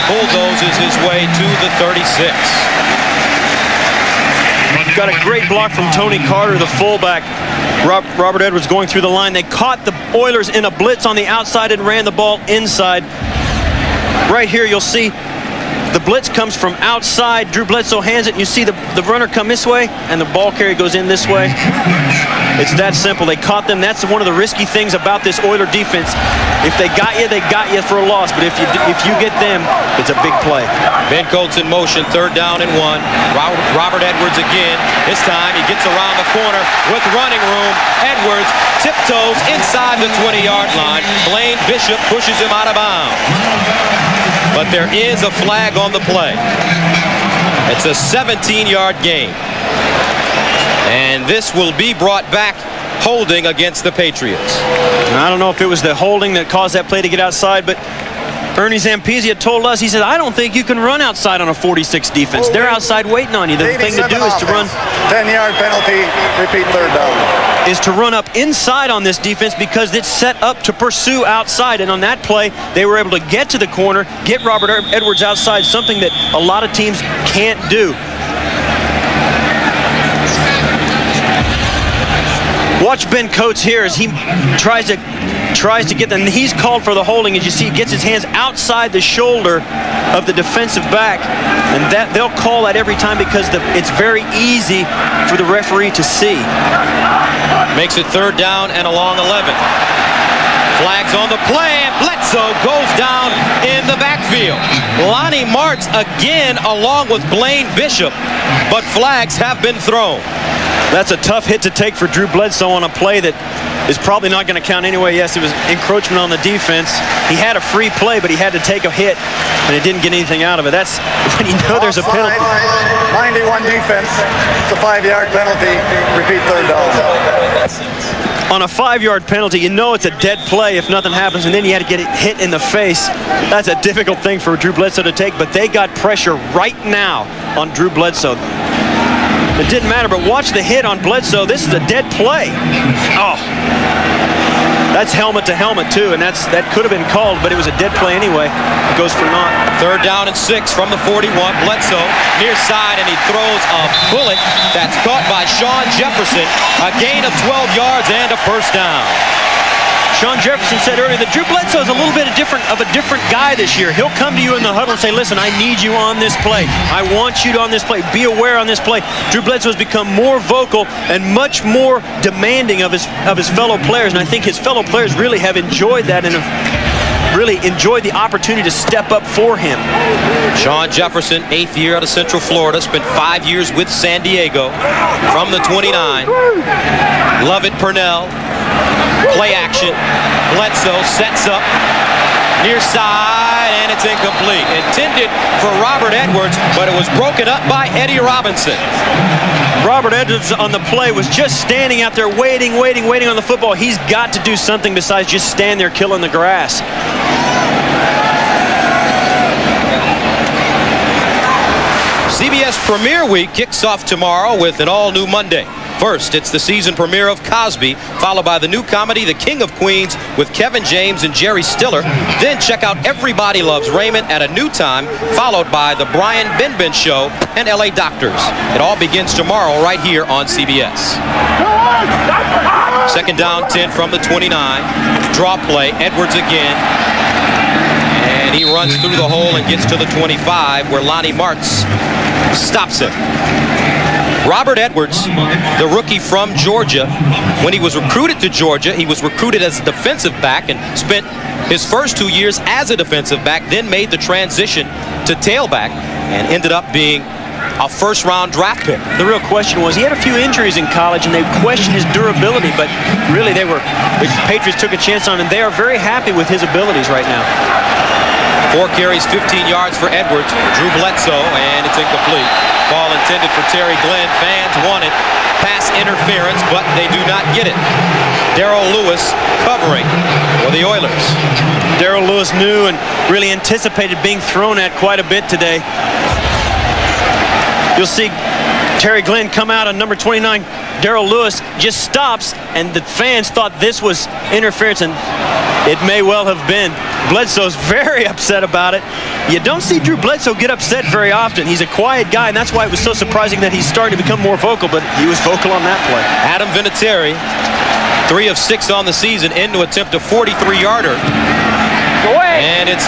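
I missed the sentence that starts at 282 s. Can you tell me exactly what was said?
Darryll Lewis knew and really anticipated being thrown at quite a bit today.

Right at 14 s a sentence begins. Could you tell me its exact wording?
Right here, you'll see the blitz comes from outside.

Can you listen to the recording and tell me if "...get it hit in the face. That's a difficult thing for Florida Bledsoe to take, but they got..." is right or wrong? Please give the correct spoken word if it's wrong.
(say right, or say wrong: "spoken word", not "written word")
wrong: "Drew", not "Florida".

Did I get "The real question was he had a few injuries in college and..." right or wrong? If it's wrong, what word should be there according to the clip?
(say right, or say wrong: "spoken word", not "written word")
right.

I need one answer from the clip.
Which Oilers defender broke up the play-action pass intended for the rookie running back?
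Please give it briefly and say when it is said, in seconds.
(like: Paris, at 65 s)
Eddie Robinson, at 197 s.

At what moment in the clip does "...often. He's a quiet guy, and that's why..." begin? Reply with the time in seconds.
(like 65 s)
301 s.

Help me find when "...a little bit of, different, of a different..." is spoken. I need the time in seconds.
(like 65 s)
161 s.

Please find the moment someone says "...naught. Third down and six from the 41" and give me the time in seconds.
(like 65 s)
149 s.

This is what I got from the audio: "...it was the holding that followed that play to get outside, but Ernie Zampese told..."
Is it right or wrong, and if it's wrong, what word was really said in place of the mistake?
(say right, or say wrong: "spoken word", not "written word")
wrong: "caused", not "followed".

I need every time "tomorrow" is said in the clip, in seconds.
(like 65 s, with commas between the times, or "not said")
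214 s, 229 s.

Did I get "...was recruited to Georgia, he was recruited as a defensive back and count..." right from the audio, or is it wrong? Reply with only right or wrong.
wrong.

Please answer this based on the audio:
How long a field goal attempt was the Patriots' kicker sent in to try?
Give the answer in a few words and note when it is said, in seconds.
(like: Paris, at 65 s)
43 yards, at 310 s.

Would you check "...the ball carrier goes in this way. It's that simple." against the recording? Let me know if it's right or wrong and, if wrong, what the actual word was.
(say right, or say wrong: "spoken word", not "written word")
right.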